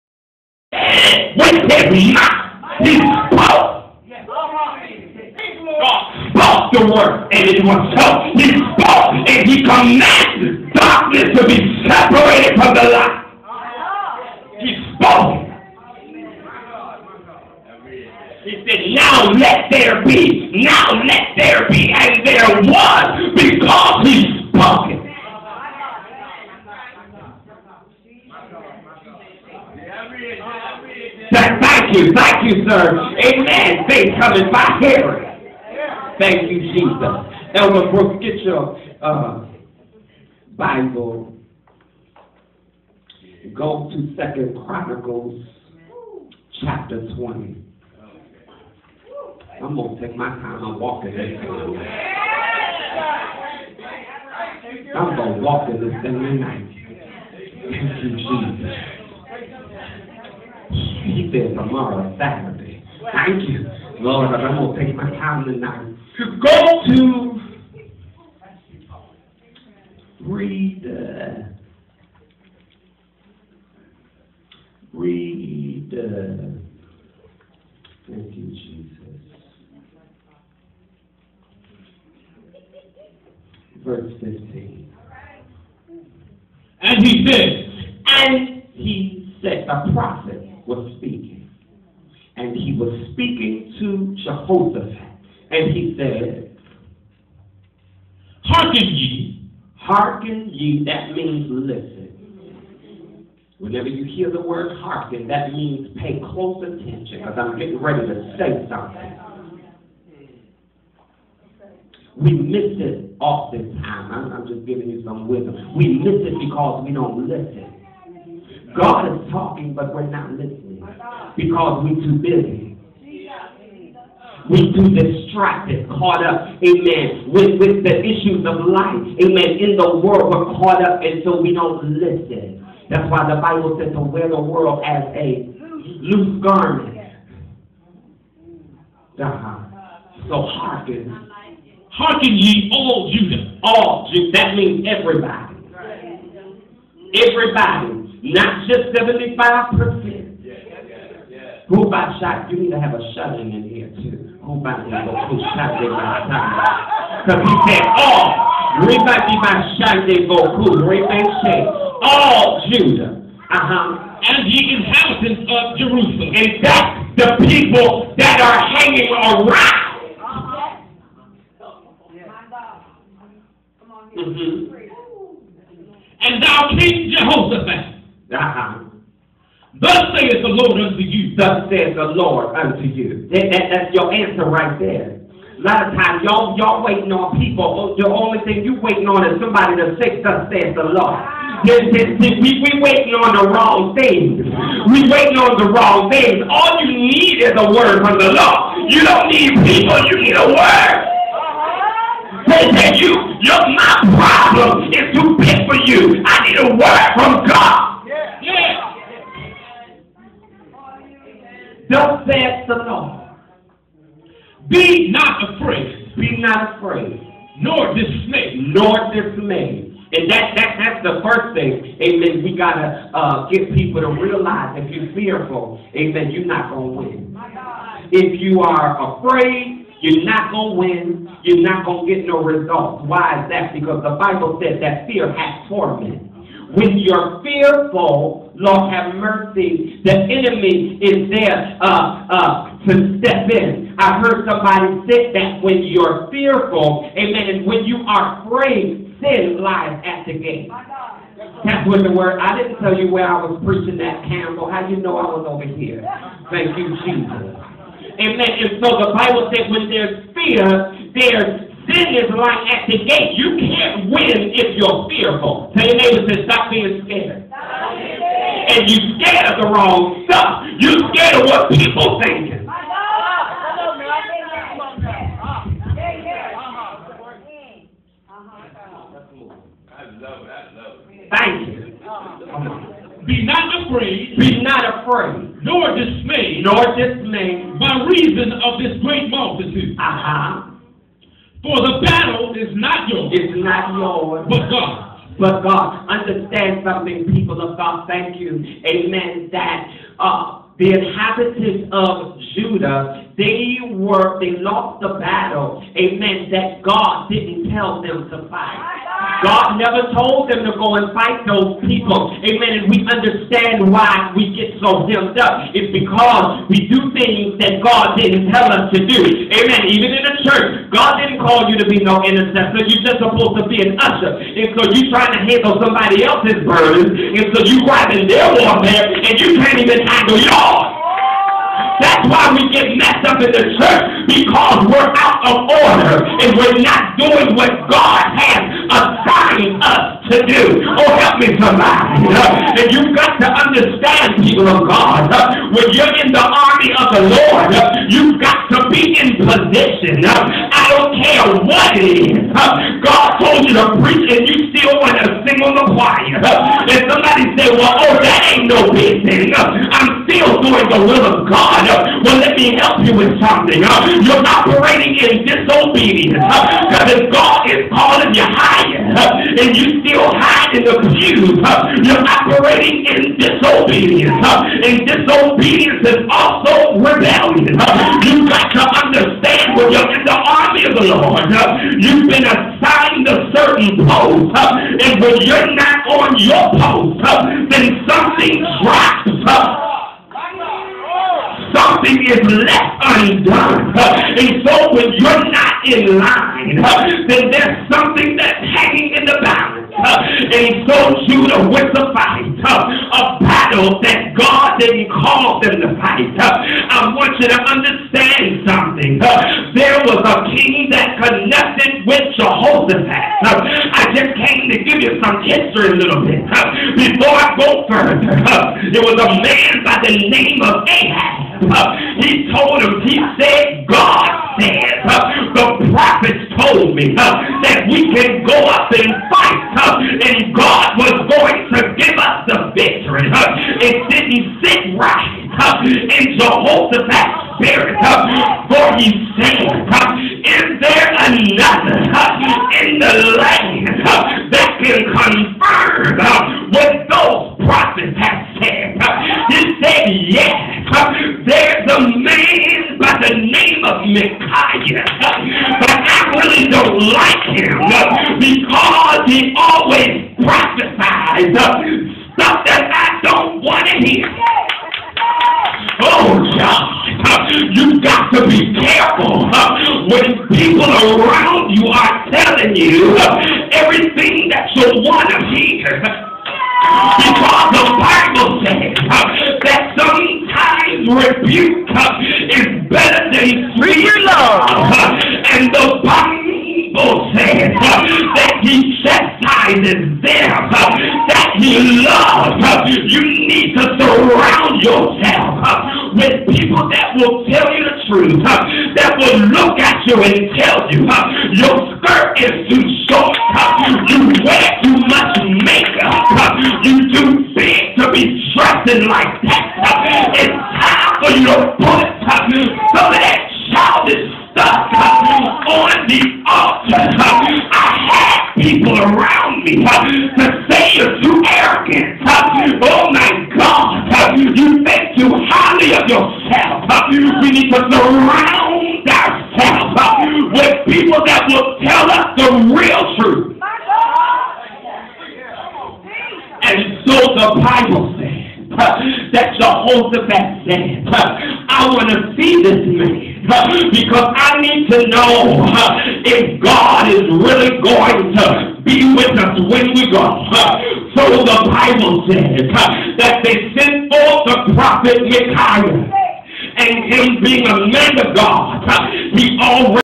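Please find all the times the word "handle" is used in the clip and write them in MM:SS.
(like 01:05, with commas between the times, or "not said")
05:25, 05:30.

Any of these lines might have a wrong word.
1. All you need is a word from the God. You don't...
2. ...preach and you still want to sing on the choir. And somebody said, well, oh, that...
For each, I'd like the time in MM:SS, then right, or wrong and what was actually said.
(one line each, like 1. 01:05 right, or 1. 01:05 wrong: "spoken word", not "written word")
1. 03:16 wrong: "Lord", not "God"
2. 05:54 right.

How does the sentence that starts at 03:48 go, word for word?
If you are afraid, you're not going to win.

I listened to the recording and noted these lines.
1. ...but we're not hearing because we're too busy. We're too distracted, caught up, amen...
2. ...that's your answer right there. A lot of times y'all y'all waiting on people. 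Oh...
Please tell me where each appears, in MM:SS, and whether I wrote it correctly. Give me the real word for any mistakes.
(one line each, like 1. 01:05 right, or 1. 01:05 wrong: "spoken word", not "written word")
1. 01:59 wrong: "listening", not "hearing"
2. 03:03 right.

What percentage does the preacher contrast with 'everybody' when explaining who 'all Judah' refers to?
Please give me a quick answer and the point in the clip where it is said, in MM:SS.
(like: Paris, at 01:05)
75%, at 02:28.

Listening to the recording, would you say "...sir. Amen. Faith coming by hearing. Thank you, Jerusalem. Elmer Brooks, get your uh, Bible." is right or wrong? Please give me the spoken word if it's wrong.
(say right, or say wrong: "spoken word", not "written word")
wrong: "Jesus", not "Jerusalem".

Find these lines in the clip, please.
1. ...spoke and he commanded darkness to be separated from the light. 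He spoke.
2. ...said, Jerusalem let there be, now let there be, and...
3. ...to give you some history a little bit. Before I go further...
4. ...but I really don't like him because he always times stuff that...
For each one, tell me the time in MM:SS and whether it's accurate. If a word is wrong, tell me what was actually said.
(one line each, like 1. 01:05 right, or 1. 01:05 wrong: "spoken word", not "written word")
1. 00:08 right
2. 00:18 wrong: "Now", not "Jerusalem"
3. 06:54 right
4. 07:35 wrong: "prophesies", not "times".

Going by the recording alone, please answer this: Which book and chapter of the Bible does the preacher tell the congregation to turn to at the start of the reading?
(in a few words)
Second Chronicles 20.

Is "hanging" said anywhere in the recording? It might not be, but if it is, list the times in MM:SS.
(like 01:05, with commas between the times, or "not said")
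02:48, 06:38.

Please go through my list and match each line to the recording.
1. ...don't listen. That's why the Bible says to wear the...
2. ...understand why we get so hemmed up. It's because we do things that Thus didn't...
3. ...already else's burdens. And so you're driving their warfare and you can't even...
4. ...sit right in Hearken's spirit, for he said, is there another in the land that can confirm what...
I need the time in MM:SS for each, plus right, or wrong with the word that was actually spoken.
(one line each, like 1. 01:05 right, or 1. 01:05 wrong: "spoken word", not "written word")
1. 02:11 right
2. 05:13 wrong: "God", not "Thus"
3. 05:25 wrong: "somebody", not "already"
4. 07:14 wrong: "Jehoshaphat", not "Hearken".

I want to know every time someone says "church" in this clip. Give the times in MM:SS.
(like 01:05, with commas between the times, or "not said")
05:20, 05:33.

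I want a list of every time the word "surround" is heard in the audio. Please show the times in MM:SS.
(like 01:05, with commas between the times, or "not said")
08:13, 08:47.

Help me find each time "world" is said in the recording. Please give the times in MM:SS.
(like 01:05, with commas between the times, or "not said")
02:10, 02:14.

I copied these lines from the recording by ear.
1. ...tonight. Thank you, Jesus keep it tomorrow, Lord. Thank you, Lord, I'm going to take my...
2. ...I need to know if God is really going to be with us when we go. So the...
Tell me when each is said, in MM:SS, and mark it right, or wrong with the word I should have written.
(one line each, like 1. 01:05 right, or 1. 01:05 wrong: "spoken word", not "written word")
1. 00:56 wrong: "Saturday", not "Lord"
2. 09:04 right.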